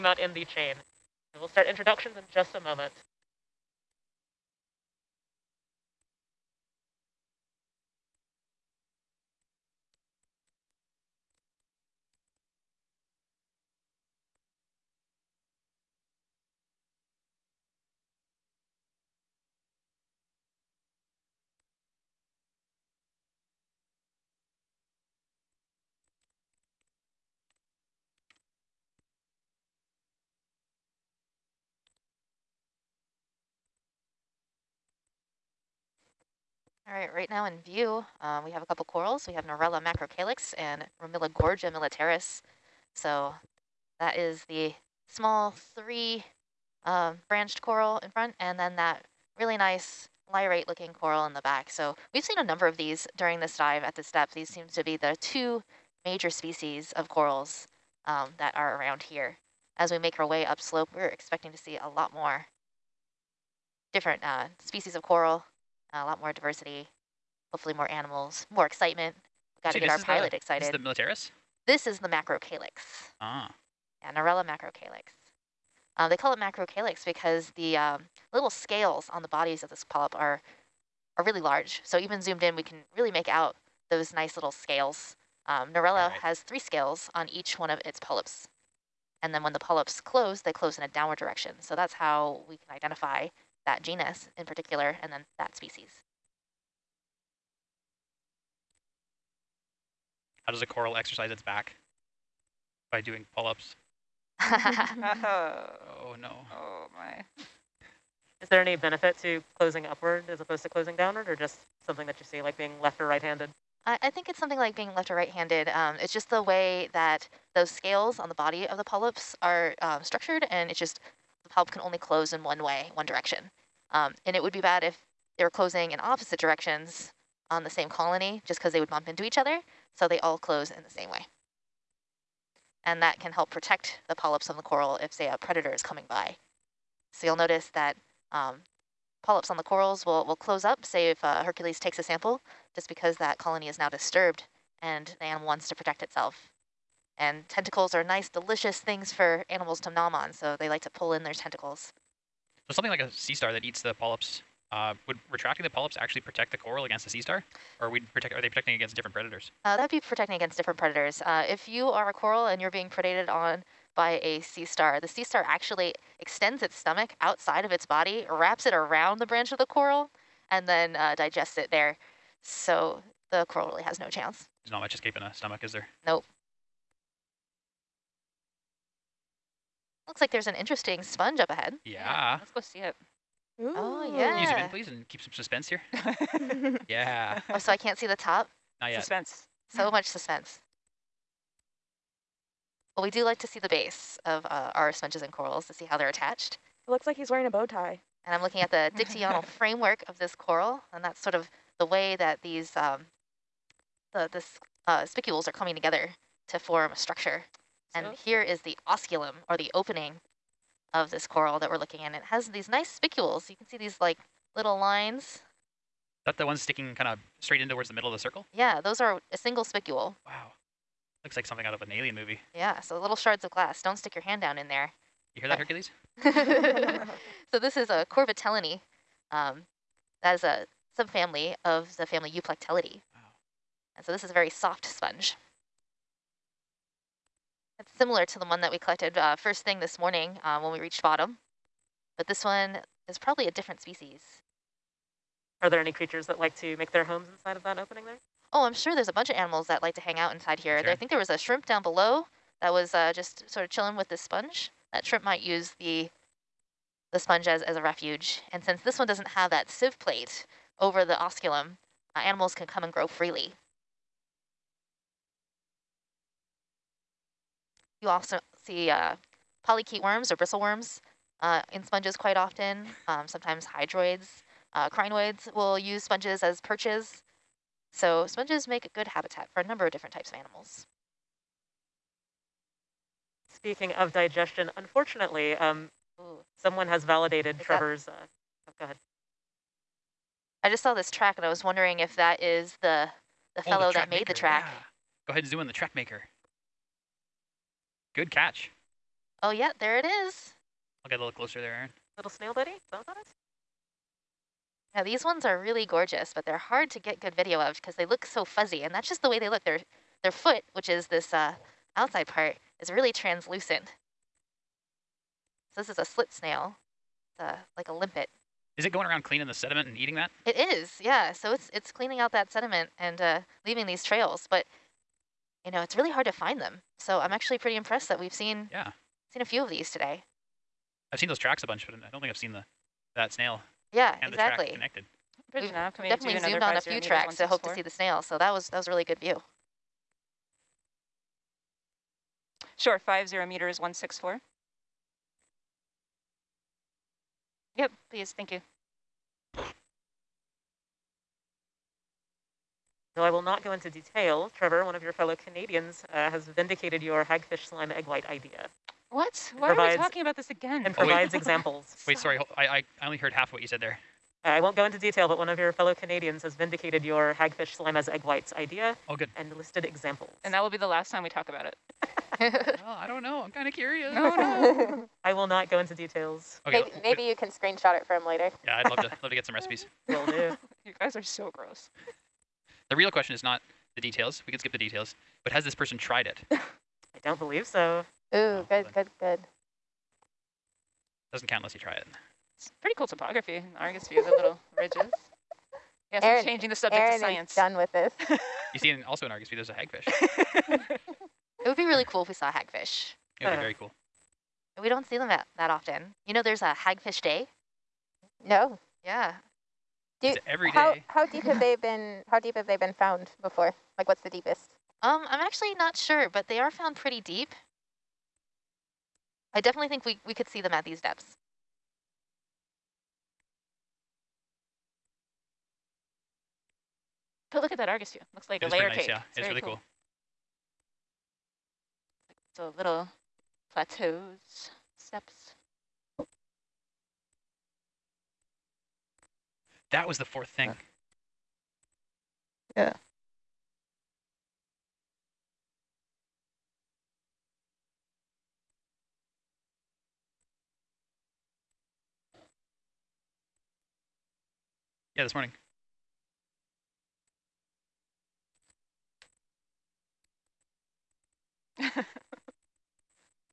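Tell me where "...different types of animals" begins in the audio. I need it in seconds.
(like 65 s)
279 s.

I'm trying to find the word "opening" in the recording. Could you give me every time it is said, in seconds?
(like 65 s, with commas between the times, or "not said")
209 s, 247 s.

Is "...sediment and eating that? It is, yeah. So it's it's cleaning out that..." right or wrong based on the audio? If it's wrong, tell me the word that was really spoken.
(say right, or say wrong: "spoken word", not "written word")
right.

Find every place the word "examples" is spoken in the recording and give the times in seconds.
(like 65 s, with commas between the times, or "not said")
361 s, 369 s.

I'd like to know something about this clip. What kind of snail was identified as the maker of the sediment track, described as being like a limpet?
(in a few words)
Slit snail.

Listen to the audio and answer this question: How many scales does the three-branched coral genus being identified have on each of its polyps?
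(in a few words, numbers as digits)
3.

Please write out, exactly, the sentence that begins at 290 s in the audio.
I just saw this track and I was wondering if that is the the oh, fellow the that made maker.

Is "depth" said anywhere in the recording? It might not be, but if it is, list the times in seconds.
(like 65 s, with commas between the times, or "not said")
54 s, 420 s.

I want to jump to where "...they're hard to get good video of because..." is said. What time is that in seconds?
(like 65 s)
306 s.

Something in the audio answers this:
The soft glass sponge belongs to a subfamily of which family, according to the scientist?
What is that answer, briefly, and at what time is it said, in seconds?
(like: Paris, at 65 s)
Euplectellidae, at 232 s.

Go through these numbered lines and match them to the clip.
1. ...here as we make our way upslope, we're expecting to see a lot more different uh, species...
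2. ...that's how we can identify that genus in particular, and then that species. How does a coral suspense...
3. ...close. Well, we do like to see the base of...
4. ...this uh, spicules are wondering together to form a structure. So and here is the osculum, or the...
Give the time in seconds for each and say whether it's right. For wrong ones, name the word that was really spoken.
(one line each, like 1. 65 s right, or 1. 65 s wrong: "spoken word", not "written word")
1. 59 s right
2. 91 s wrong: "exercise", not "suspense"
3. 190 s wrong: "suspense", not "close"
4. 204 s wrong: "coming", not "wondering".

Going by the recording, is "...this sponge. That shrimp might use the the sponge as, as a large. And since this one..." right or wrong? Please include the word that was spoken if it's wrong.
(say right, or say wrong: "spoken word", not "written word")
wrong: "refuge", not "large".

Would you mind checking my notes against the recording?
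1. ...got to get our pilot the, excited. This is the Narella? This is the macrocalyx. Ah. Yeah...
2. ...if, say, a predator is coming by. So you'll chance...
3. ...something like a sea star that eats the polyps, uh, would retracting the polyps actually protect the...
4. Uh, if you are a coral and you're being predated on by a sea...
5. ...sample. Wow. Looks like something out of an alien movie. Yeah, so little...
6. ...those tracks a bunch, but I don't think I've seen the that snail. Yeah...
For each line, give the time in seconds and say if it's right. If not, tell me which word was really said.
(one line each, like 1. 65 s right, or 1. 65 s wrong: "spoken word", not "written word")
1. 69 s wrong: "Militaris", not "Narella"
2. 135 s wrong: "notice", not "chance"
3. 152 s right
4. 161 s right
5. 219 s wrong: "spicule", not "sample"
6. 331 s right.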